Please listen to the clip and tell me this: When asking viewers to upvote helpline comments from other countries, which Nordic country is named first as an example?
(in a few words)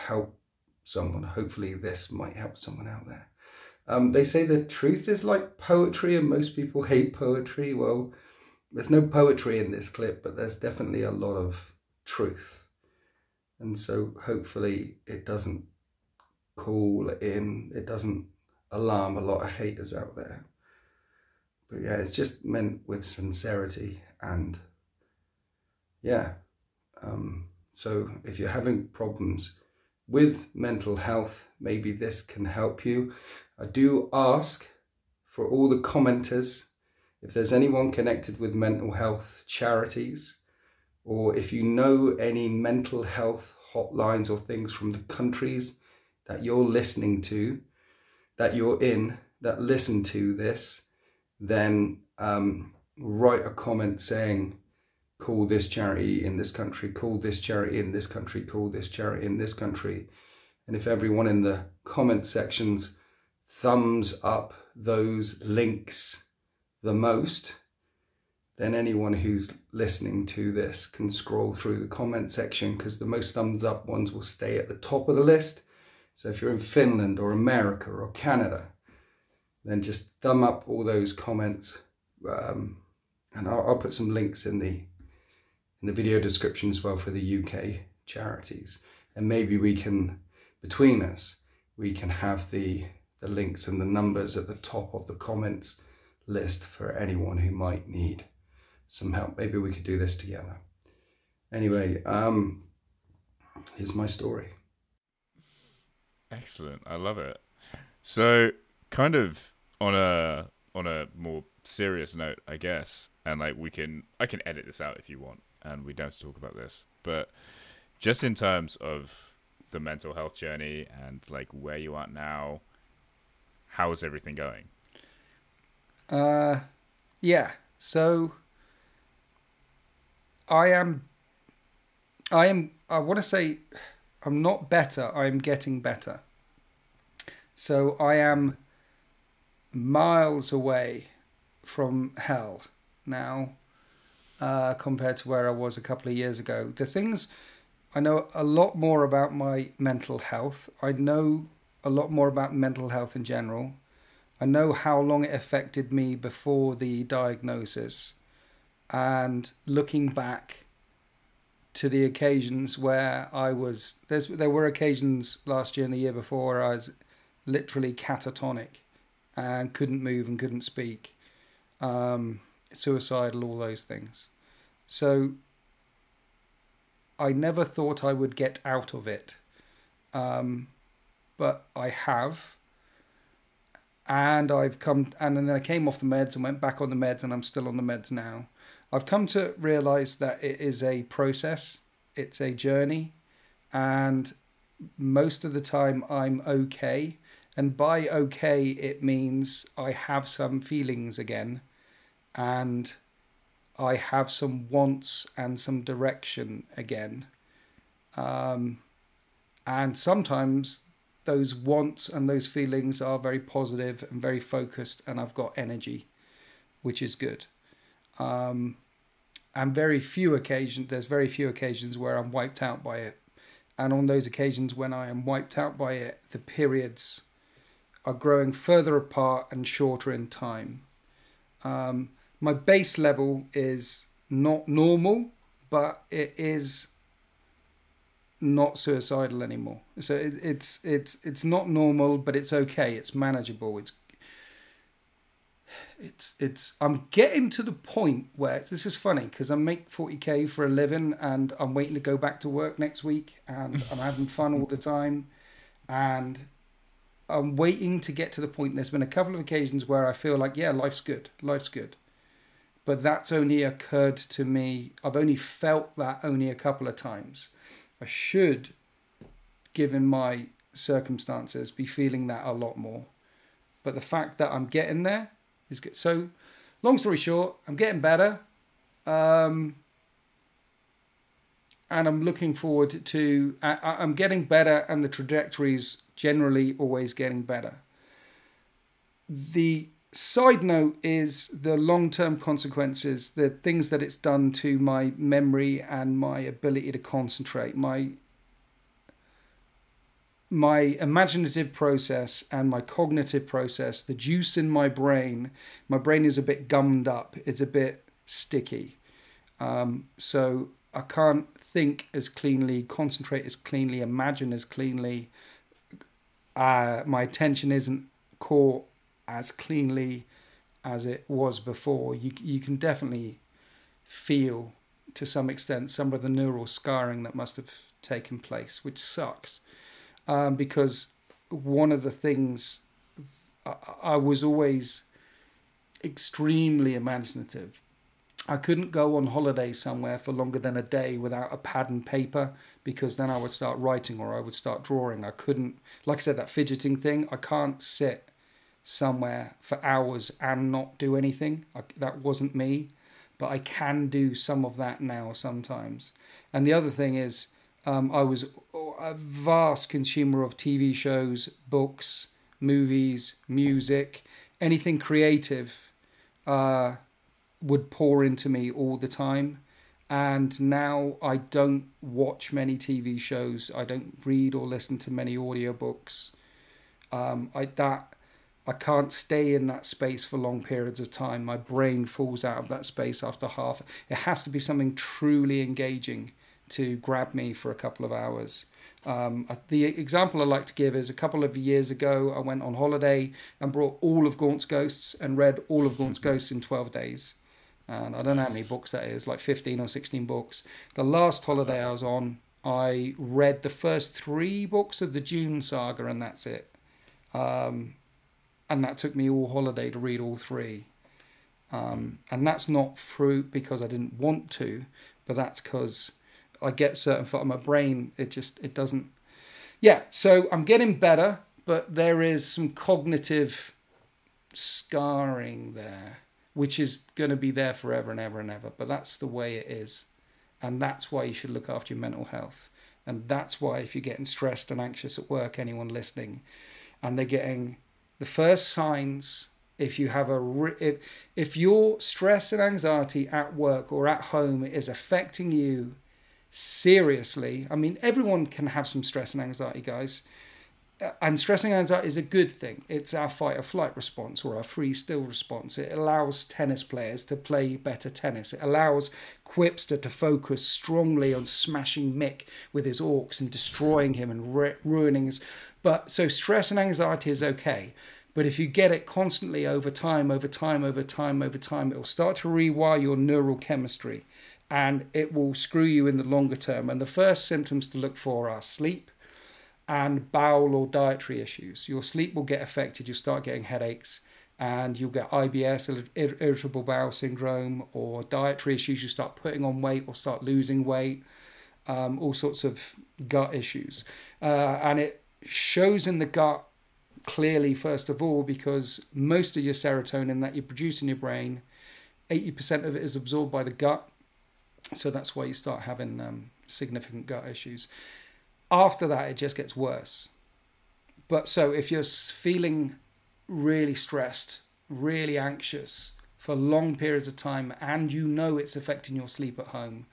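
Finland.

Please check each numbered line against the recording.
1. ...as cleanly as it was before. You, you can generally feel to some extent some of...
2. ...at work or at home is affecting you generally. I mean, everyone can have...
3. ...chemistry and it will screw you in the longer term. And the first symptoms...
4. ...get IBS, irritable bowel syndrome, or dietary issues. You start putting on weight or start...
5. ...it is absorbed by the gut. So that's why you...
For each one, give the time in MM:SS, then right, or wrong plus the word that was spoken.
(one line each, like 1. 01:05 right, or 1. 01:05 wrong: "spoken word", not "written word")
1. 05:19 wrong: "definitely", not "generally"
2. 07:23 wrong: "seriously", not "generally"
3. 07:53 right
4. 08:05 right
5. 08:22 right.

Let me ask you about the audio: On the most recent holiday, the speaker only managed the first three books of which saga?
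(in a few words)
Dune.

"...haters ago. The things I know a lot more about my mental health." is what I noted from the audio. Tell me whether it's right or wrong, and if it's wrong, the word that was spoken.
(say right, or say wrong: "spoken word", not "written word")
wrong: "years", not "haters".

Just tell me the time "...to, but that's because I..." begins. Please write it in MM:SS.
06:54.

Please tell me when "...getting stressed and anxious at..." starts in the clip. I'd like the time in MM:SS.
07:14.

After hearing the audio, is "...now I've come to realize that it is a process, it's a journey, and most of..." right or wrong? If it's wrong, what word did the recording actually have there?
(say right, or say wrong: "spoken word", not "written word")
right.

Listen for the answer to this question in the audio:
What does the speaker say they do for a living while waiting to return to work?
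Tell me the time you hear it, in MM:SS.
04:09.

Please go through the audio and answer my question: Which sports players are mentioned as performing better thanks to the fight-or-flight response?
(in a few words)
Tennis players.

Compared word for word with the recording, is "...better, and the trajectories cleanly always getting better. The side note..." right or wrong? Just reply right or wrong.
wrong.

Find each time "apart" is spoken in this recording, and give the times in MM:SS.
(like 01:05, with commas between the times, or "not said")
03:48.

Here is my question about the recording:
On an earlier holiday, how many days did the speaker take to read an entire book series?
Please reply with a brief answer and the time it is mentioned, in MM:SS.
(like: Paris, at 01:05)
12 days, at 06:36.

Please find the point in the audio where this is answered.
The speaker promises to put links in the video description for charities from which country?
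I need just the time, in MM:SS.
01:27.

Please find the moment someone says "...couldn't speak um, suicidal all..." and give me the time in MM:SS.
02:50.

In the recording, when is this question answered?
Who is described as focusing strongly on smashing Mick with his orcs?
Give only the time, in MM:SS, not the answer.
07:39.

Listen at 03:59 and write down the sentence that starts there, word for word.
So it, it's it's it's not normal, but it's okay.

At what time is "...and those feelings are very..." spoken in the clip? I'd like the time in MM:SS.
03:32.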